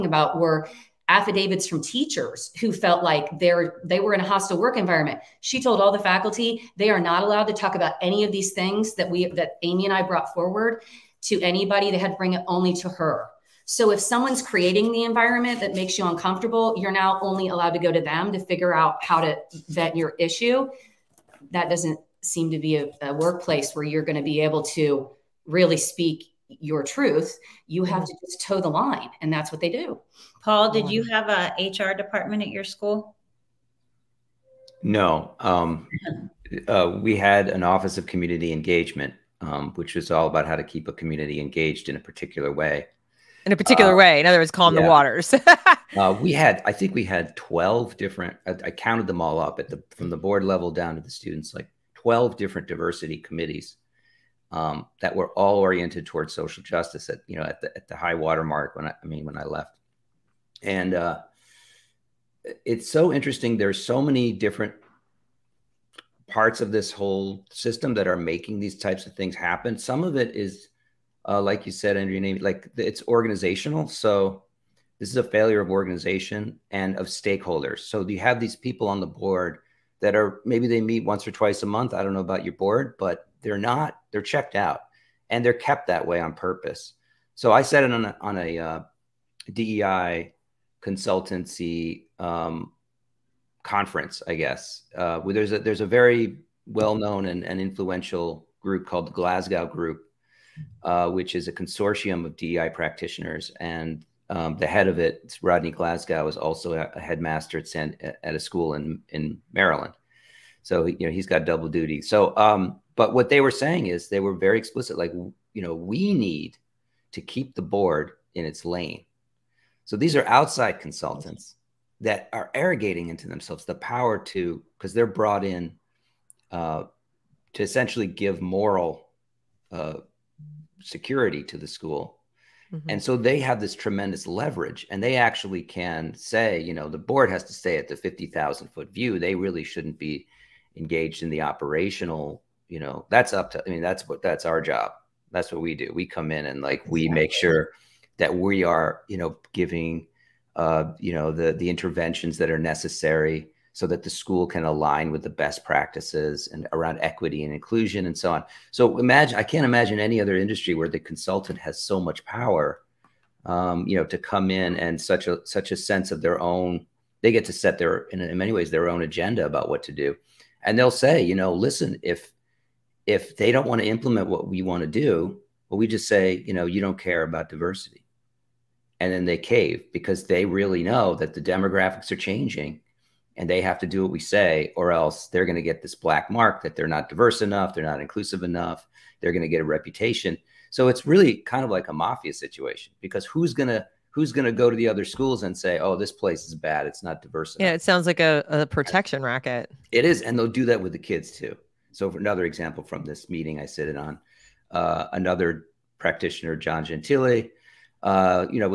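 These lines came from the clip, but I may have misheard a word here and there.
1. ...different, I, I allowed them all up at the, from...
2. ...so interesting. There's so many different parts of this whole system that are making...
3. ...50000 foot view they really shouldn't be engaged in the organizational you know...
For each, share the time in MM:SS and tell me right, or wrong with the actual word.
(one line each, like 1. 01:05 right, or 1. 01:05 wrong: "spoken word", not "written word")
1. 00:47 wrong: "counted", not "allowed"
2. 01:02 right
3. 02:17 wrong: "operational", not "organizational".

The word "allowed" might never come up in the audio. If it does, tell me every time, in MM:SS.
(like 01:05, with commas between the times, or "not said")
00:07, 00:17.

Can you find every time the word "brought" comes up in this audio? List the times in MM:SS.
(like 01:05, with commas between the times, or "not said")
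00:10, 02:05.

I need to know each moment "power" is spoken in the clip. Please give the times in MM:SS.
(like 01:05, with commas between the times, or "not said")
02:03, 02:42.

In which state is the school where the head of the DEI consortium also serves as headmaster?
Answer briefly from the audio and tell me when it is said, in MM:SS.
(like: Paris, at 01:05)
Maryland, at 01:49.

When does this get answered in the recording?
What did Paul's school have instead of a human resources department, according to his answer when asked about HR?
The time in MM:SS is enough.
00:37.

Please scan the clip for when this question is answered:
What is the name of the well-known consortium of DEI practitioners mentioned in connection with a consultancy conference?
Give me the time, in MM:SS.
01:39.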